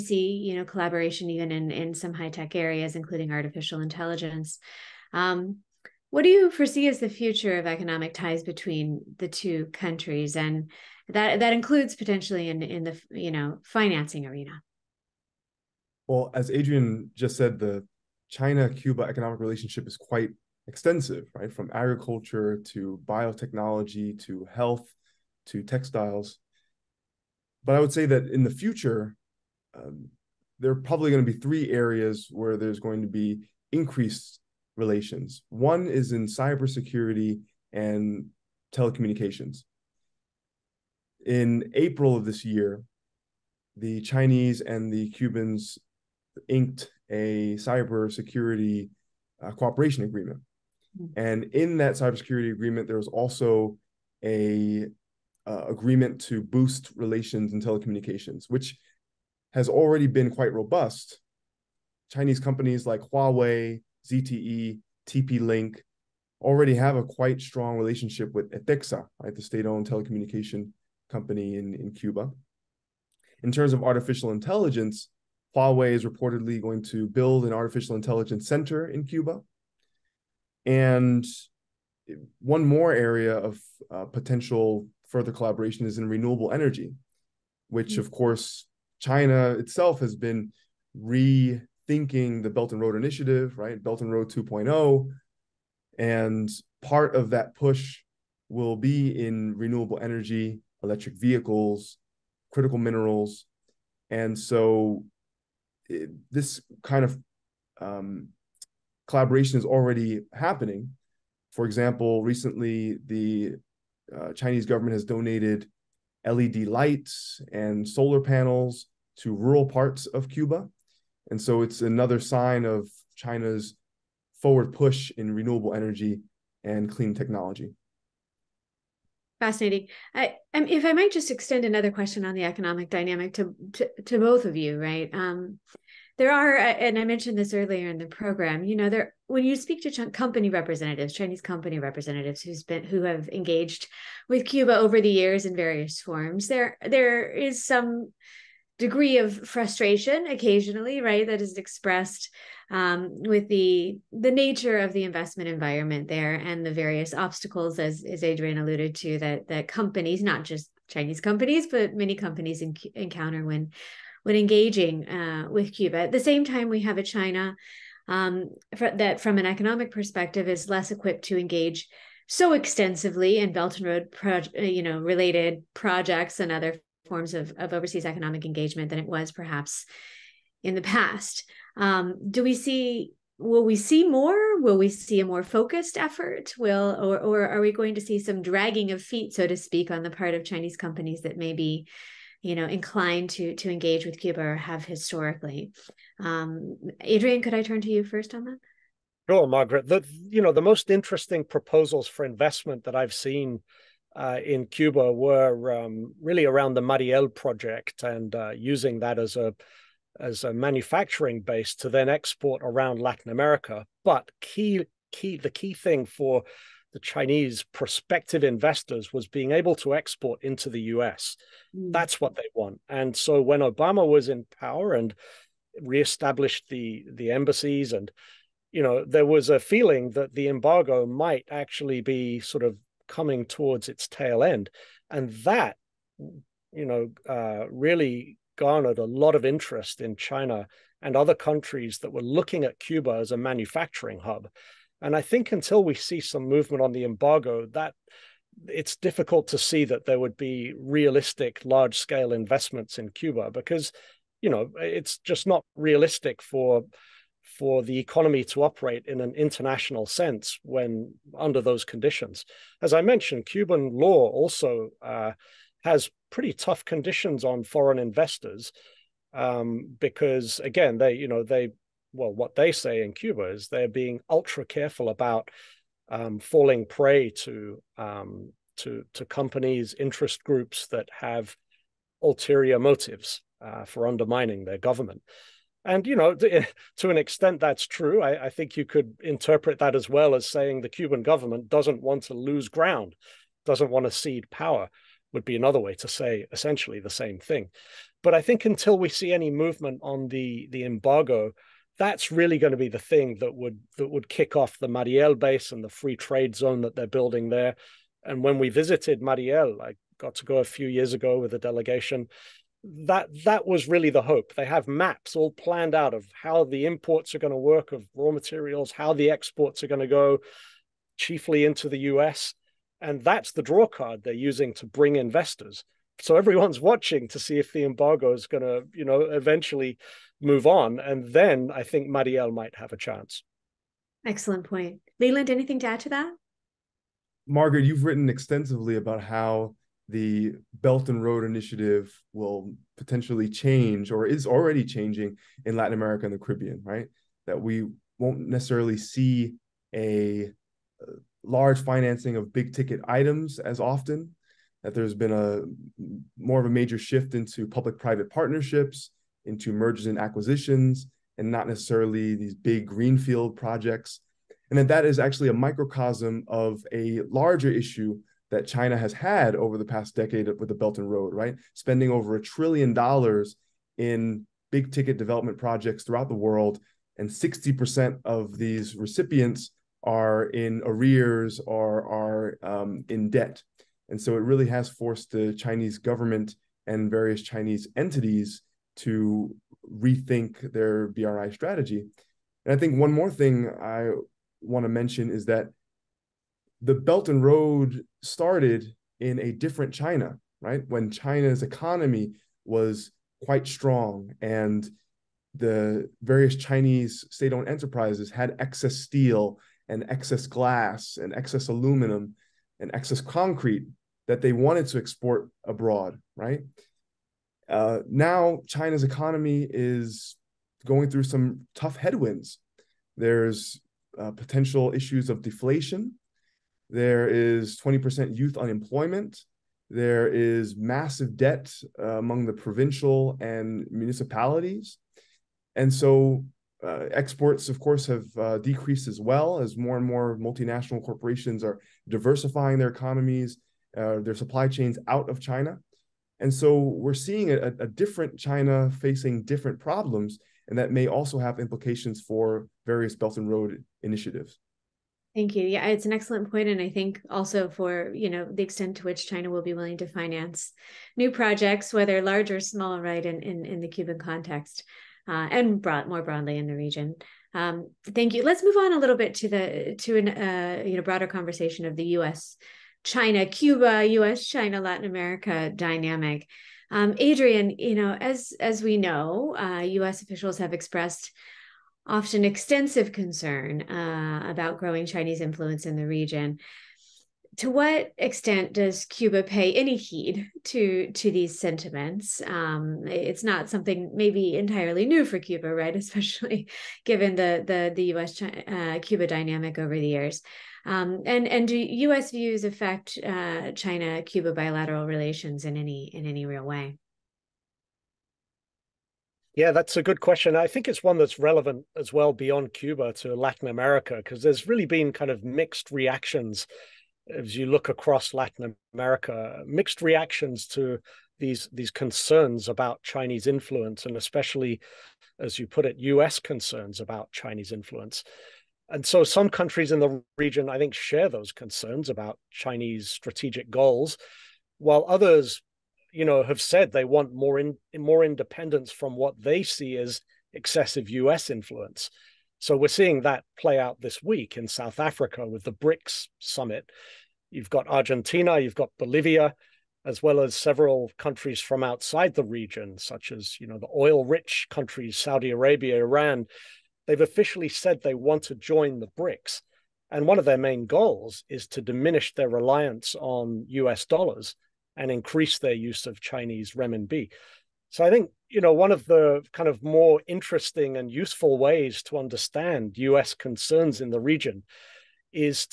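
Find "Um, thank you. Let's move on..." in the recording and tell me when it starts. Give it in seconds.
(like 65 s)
467 s.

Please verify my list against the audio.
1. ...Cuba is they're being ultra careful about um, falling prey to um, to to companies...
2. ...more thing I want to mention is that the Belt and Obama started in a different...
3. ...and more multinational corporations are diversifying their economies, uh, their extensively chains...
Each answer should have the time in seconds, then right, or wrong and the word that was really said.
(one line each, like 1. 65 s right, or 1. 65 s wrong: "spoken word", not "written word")
1. 273 s right
2. 393 s wrong: "Road", not "Obama"
3. 439 s wrong: "supply", not "extensively".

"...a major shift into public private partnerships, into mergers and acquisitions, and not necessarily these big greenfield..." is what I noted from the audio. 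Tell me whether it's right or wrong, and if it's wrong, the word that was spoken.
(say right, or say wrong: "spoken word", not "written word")
right.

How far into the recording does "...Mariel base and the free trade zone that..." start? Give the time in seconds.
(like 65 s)
304 s.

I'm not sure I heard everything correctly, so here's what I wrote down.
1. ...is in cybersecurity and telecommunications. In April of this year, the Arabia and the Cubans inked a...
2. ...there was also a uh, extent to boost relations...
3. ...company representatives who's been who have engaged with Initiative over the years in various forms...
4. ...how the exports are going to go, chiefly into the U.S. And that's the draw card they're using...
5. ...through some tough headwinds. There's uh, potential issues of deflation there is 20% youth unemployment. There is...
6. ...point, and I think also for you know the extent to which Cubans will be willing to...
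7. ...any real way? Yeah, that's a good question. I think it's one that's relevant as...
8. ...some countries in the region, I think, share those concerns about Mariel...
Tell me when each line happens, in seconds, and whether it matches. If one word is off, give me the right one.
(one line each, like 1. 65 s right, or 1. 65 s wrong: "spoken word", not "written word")
1. 35 s wrong: "Chinese", not "Arabia"
2. 52 s wrong: "agreement", not "extent"
3. 141 s wrong: "Cuba", not "Initiative"
4. 318 s right
5. 421 s right
6. 456 s wrong: "China", not "Cubans"
7. 506 s right
8. 529 s wrong: "Chinese", not "Mariel".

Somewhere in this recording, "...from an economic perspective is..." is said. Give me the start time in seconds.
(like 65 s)
169 s.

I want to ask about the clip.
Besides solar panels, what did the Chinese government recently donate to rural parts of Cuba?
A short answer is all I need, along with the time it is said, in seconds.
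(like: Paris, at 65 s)
LED lights, at 116 s.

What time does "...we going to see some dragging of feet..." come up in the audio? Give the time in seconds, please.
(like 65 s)
187 s.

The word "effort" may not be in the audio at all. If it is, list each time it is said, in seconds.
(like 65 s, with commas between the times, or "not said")
185 s.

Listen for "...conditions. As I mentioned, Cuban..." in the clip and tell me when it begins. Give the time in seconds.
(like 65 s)
261 s.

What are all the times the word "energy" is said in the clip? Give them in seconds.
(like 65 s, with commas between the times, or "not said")
86 s, 99 s, 125 s.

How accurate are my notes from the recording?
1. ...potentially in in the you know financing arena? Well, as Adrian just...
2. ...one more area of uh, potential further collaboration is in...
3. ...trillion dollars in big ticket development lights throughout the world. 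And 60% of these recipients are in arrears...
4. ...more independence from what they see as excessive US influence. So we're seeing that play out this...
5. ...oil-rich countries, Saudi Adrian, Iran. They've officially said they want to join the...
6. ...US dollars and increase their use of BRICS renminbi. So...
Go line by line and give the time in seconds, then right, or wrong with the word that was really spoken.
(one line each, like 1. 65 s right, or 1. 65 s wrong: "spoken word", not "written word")
1. 11 s right
2. 82 s right
3. 372 s wrong: "projects", not "lights"
4. 537 s right
5. 553 s wrong: "Arabia", not "Adrian"
6. 563 s wrong: "Chinese", not "BRICS".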